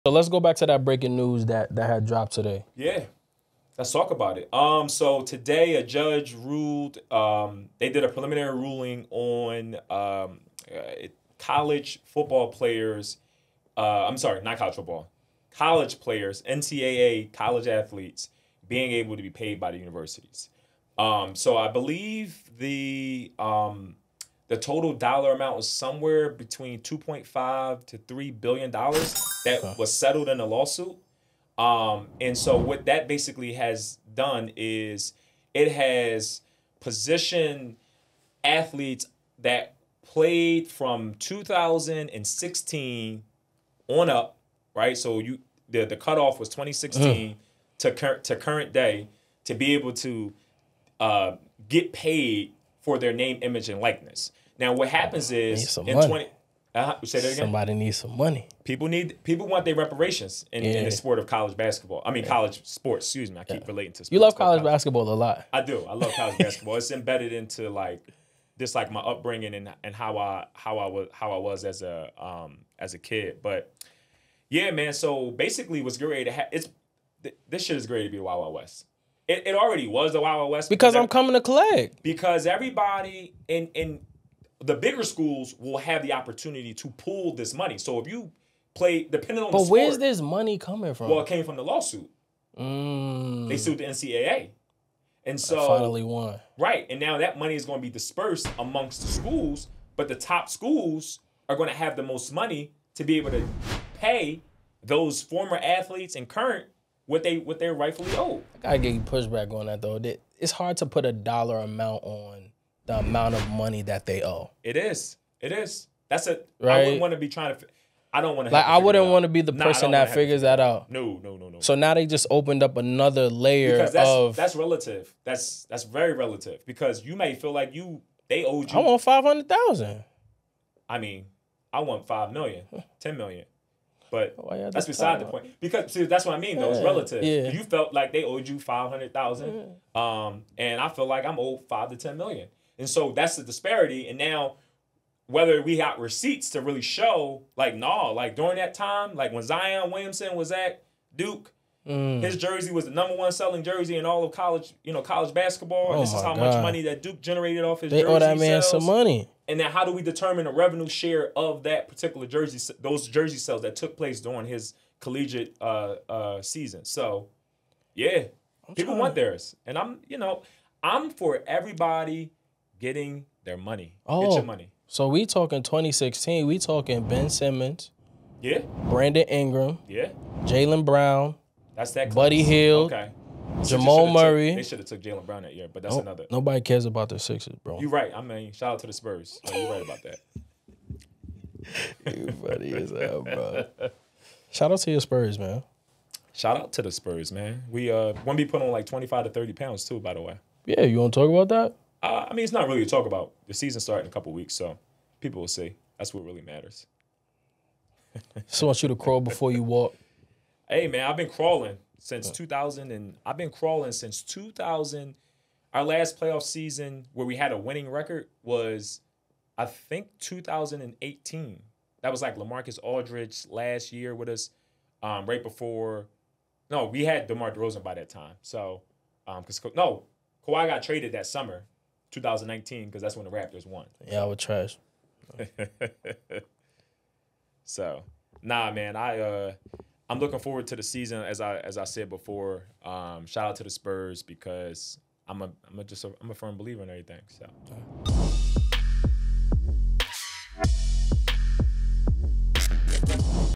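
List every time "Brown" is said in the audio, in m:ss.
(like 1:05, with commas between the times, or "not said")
3:00, 3:05.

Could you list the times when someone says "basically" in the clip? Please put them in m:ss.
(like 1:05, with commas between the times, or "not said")
0:33, 1:15.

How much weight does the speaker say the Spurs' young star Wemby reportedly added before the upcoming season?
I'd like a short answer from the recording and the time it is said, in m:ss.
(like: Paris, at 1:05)
25 to 30 pounds, at 3:18.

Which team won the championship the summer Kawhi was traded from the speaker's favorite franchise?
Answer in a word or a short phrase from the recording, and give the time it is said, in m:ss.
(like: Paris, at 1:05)
Raptors, at 3:53.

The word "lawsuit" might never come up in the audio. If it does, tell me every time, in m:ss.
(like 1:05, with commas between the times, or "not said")
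0:30, 1:31.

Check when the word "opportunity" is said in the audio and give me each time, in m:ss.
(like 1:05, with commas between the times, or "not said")
1:26.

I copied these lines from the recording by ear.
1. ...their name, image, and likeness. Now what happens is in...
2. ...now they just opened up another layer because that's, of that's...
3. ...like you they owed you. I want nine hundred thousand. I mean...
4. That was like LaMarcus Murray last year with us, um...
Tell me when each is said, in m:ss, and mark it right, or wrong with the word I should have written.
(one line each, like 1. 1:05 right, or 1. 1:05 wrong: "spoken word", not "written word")
1. 0:52 right
2. 2:01 right
3. 2:07 wrong: "five", not "nine"
4. 3:42 wrong: "Aldridge", not "Murray".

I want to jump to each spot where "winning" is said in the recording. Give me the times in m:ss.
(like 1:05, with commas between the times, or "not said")
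3:37.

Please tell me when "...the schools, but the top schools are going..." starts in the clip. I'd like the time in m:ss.
1:39.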